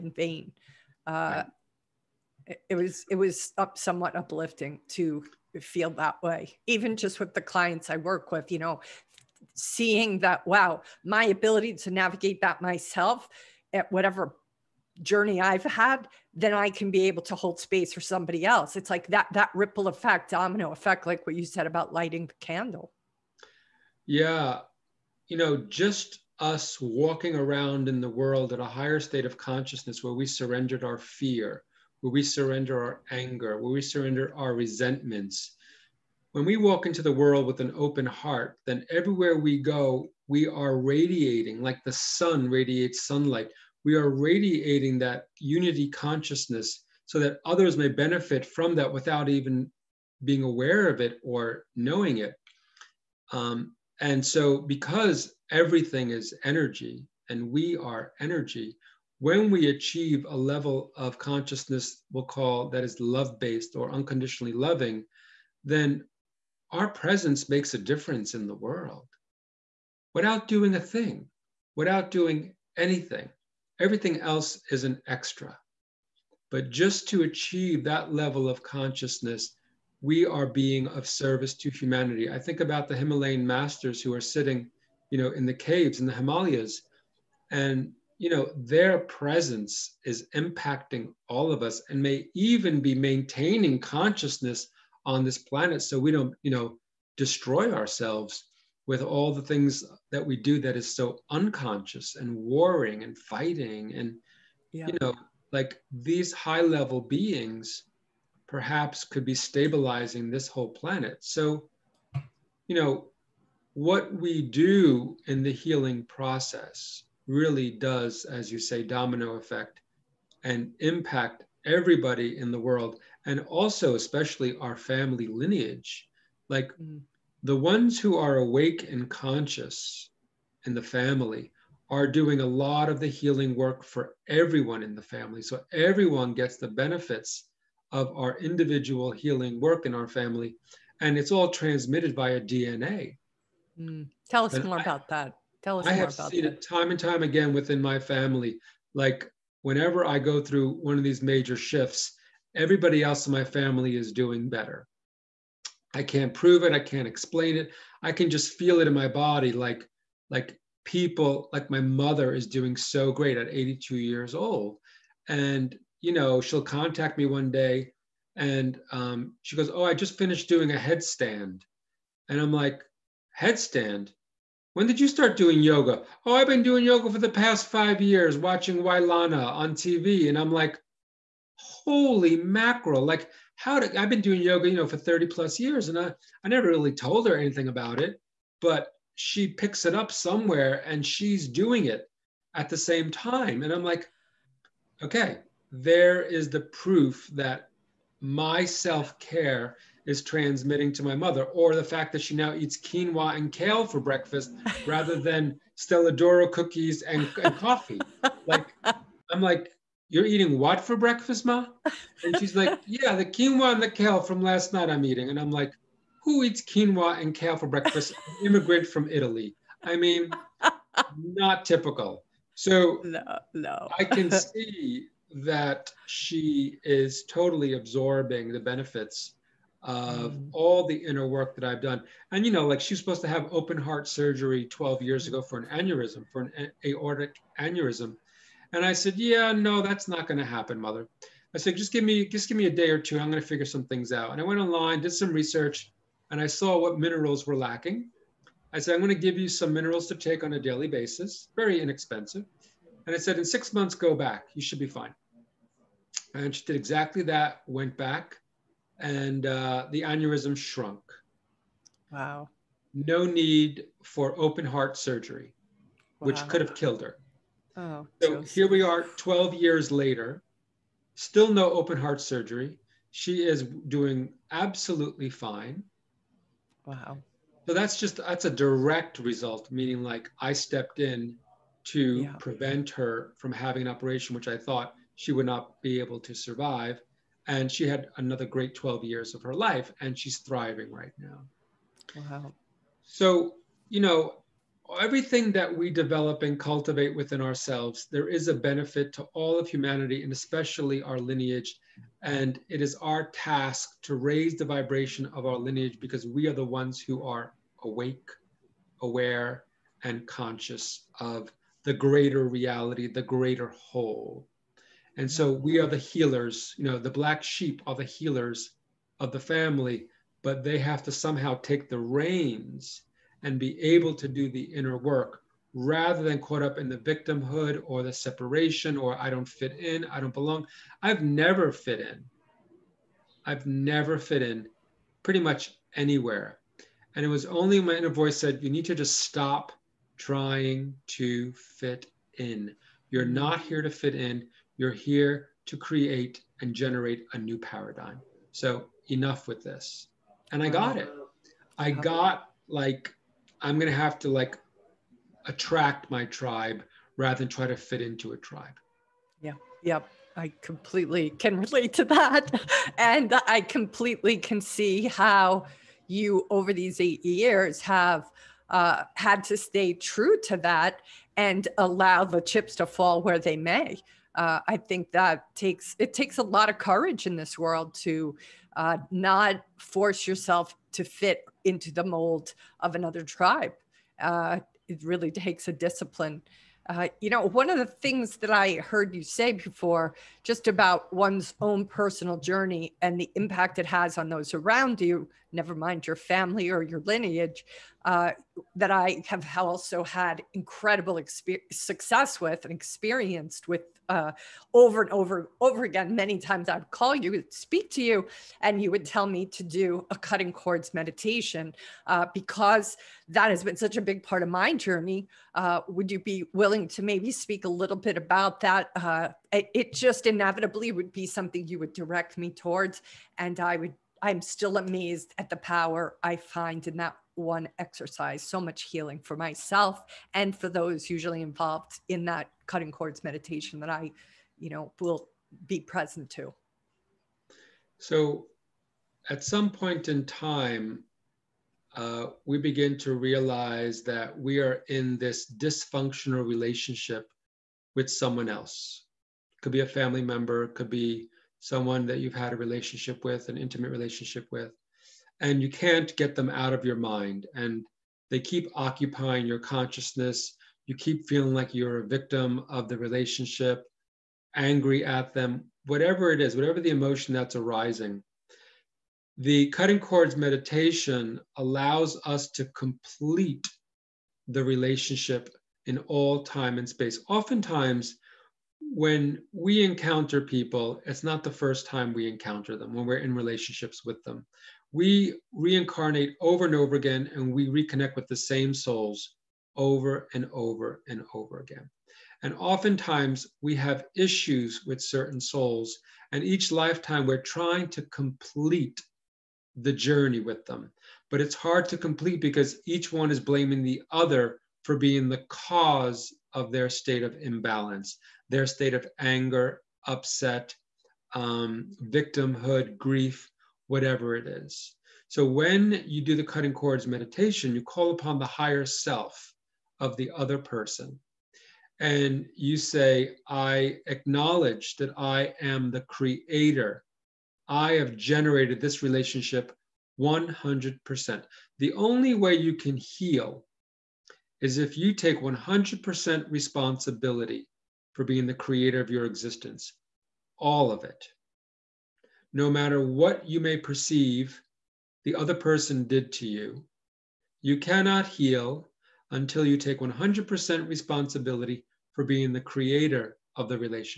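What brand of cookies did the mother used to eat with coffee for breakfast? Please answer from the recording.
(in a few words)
Stella D'oro.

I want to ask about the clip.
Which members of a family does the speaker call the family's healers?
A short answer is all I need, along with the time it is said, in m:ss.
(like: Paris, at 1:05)
The black sheep, at 5:16.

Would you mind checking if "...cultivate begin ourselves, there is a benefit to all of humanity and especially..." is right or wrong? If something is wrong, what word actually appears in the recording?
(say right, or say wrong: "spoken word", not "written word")
wrong: "within", not "begin".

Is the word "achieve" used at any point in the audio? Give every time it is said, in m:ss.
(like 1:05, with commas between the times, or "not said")
0:59, 1:17.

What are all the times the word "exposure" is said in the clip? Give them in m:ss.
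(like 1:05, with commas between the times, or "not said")
not said.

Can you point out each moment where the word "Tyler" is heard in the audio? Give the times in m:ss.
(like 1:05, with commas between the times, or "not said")
not said.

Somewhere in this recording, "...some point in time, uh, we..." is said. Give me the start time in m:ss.
7:19.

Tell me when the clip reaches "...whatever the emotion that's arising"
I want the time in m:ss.
7:46.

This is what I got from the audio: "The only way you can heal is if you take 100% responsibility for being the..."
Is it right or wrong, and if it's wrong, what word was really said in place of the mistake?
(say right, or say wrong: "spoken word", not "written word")
right.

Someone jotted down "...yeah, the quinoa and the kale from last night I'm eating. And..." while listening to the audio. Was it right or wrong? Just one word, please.
right.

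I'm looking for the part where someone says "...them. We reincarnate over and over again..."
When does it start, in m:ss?
8:04.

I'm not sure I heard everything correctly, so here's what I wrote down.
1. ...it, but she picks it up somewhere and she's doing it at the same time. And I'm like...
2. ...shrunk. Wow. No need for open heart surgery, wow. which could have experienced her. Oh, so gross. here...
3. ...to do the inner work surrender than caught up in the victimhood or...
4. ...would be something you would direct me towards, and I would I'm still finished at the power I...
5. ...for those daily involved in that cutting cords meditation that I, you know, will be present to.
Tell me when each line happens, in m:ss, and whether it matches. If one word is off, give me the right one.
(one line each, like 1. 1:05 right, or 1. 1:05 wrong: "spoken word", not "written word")
1. 3:07 right
2. 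4:20 wrong: "killed", not "experienced"
3. 5:24 wrong: "rather", not "surrender"
4. 7:00 wrong: "amazed", not "finished"
5. 7:10 wrong: "usually", not "daily".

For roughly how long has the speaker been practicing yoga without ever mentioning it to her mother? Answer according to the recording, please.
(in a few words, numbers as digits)
30 plus years.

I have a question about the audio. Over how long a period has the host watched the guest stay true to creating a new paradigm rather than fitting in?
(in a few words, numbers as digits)
8 years.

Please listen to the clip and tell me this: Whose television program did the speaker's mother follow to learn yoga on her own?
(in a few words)
Wai Lana.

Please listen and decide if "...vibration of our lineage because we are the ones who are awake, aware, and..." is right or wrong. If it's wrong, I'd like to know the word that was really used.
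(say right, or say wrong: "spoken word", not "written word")
right.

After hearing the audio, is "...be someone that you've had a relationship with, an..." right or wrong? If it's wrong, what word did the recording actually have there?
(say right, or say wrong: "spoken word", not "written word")
right.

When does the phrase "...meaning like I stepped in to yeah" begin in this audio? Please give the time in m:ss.
4:39.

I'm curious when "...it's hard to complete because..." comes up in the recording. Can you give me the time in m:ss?
8:21.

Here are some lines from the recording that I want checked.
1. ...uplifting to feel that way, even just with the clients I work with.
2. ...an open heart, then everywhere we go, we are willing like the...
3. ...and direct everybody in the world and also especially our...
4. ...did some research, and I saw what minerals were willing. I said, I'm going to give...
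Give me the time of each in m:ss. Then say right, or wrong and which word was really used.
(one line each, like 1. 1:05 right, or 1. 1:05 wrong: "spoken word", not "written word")
1. 0:04 right
2. 0:37 wrong: "radiating", not "willing"
3. 2:00 wrong: "impact", not "direct"
4. 4:04 wrong: "lacking", not "willing".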